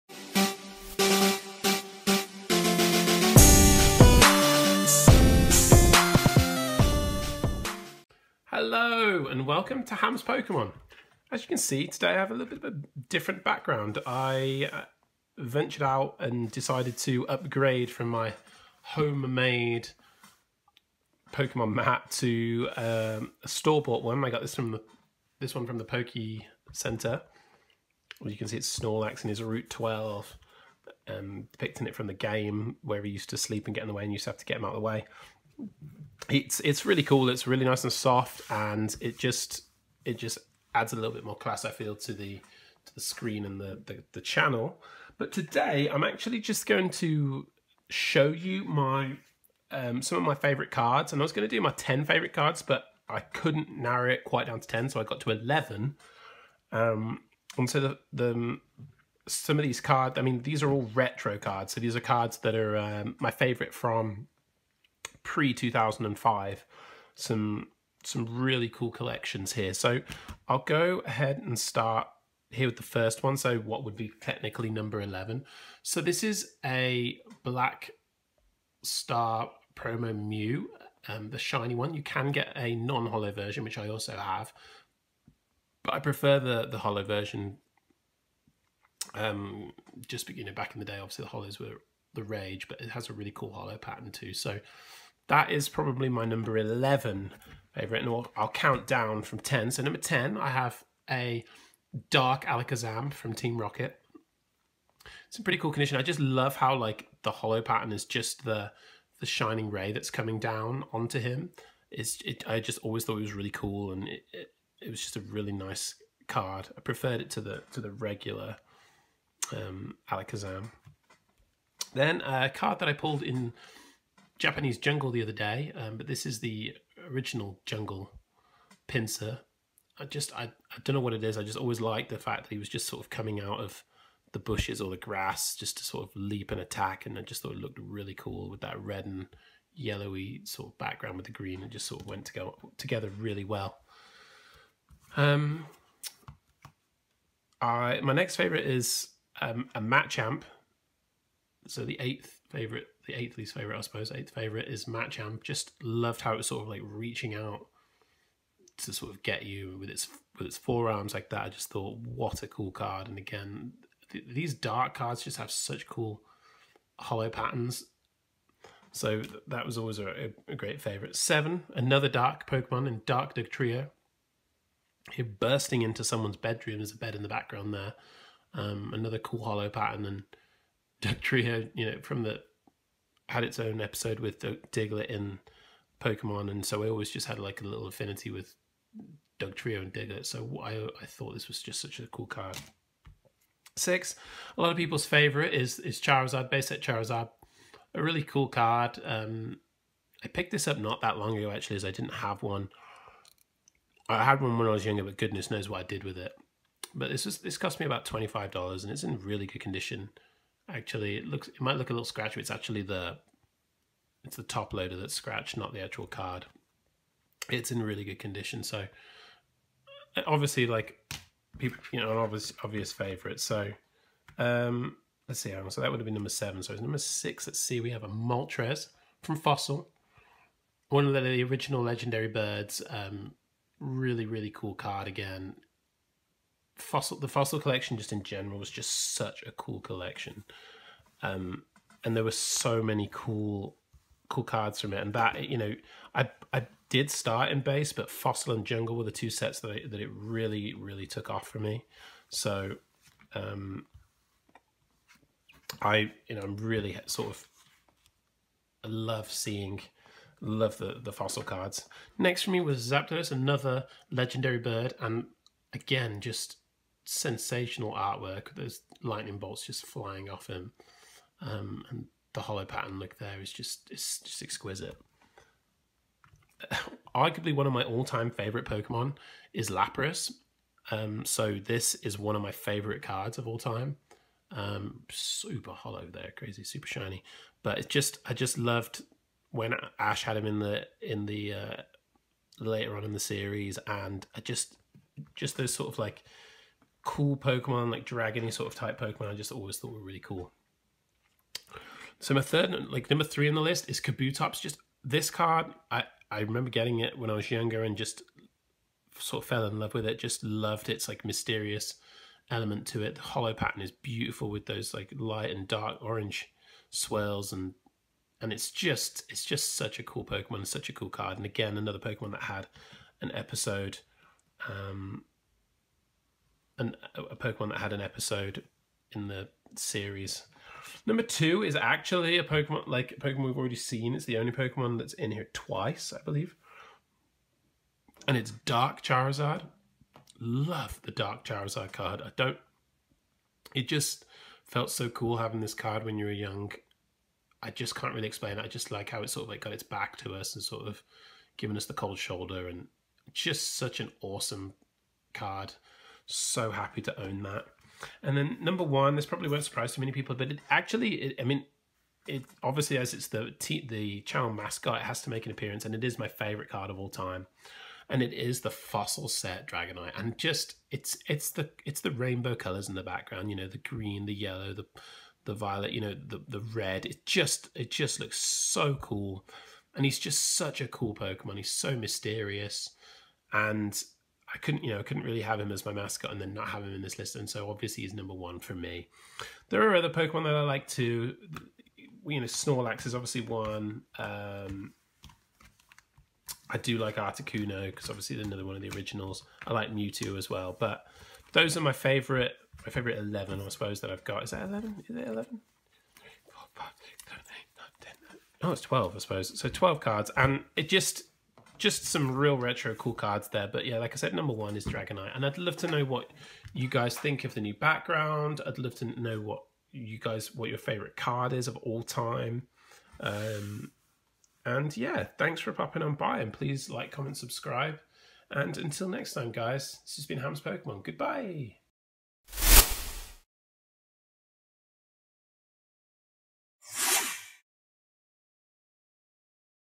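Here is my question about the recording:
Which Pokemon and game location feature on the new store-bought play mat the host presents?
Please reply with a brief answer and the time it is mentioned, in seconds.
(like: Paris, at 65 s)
Snorlax, Route 12, at 28 s.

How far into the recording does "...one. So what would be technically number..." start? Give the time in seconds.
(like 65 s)
73 s.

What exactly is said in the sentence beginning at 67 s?
Some some really cool collections here.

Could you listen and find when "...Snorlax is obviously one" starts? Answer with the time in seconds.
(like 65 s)
392 s.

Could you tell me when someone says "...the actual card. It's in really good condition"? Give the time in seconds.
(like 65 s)
215 s.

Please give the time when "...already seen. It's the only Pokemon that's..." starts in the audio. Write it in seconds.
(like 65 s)
333 s.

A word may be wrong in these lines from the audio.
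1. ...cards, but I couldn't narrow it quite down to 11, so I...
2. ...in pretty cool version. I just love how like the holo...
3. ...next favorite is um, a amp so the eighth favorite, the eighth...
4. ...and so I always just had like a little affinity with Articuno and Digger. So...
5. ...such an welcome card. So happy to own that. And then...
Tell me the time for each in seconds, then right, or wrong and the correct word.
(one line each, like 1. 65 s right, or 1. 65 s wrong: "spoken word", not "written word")
1. 52 s wrong: "10", not "11"
2. 105 s wrong: "condition", not "version"
3. 148 s right
4. 186 s wrong: "Dugtrio", not "Articuno"
5. 353 s wrong: "awesome", not "welcome".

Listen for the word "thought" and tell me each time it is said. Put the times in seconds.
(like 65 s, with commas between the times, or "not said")
113 s, 137 s, 161 s, 191 s, 299 s.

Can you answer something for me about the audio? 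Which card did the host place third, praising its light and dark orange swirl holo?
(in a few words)
Kabutops.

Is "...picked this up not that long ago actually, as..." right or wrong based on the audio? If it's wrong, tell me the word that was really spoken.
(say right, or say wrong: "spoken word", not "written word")
right.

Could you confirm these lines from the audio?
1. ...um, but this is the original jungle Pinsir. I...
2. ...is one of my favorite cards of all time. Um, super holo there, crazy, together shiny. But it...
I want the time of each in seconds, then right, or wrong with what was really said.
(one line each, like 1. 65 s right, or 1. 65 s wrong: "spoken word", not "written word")
1. 125 s right
2. 281 s wrong: "super", not "together".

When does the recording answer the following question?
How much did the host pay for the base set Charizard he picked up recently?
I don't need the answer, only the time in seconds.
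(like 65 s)
208 s.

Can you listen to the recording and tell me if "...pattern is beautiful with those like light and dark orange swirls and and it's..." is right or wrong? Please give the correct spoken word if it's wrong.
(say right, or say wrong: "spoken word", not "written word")
right.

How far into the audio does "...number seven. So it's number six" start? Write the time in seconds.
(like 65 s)
226 s.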